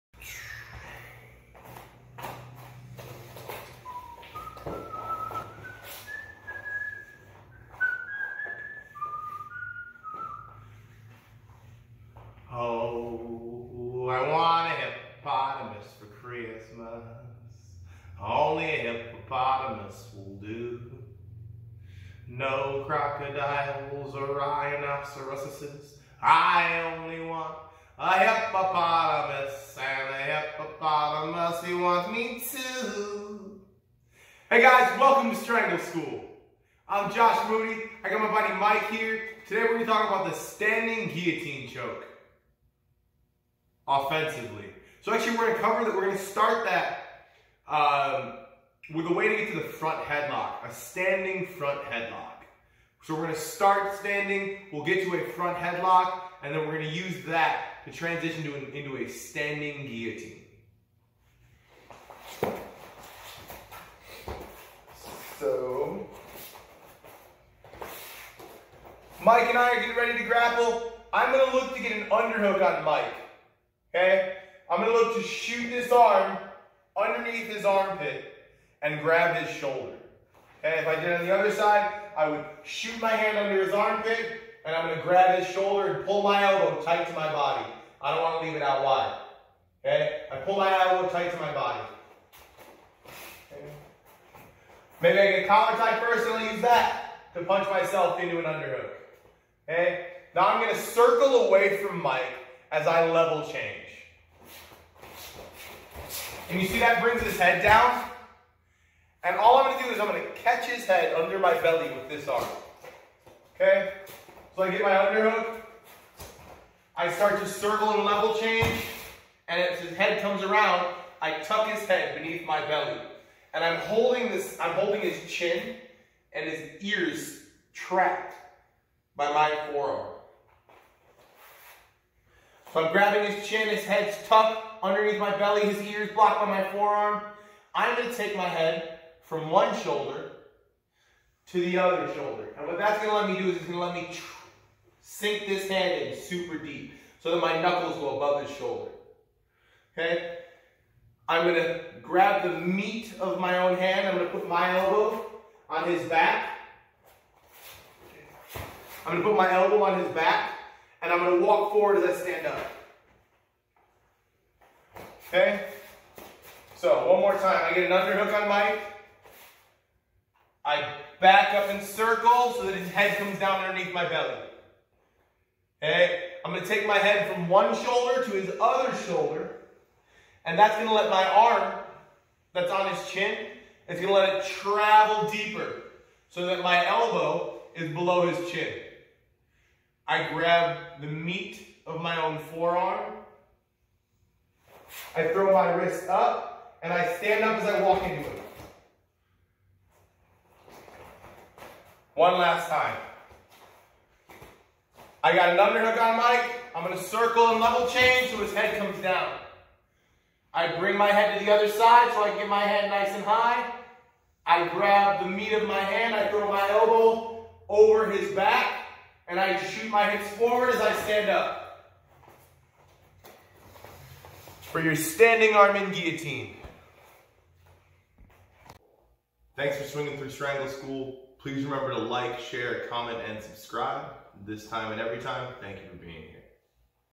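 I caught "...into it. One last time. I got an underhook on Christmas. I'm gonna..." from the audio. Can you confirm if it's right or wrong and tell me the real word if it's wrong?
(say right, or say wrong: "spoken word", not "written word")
wrong: "Mike", not "Christmas".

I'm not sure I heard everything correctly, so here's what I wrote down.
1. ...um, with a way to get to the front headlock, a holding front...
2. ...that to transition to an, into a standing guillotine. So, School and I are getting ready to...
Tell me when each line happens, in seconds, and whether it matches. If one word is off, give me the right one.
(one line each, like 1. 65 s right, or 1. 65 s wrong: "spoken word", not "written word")
1. 47 s wrong: "standing", not "holding"
2. 57 s wrong: "Mike", not "School".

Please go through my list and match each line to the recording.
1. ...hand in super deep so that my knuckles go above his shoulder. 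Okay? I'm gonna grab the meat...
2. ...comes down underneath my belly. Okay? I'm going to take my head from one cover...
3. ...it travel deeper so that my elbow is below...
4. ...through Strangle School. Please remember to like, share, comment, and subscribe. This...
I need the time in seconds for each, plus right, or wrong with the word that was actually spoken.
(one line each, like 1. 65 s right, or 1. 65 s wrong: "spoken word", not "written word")
1. 145 s right
2. 173 s wrong: "shoulder", not "cover"
3. 184 s right
4. 230 s right.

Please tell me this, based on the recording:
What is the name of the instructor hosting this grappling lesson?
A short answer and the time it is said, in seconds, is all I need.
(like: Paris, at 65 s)
Josh Moody, at 37 s.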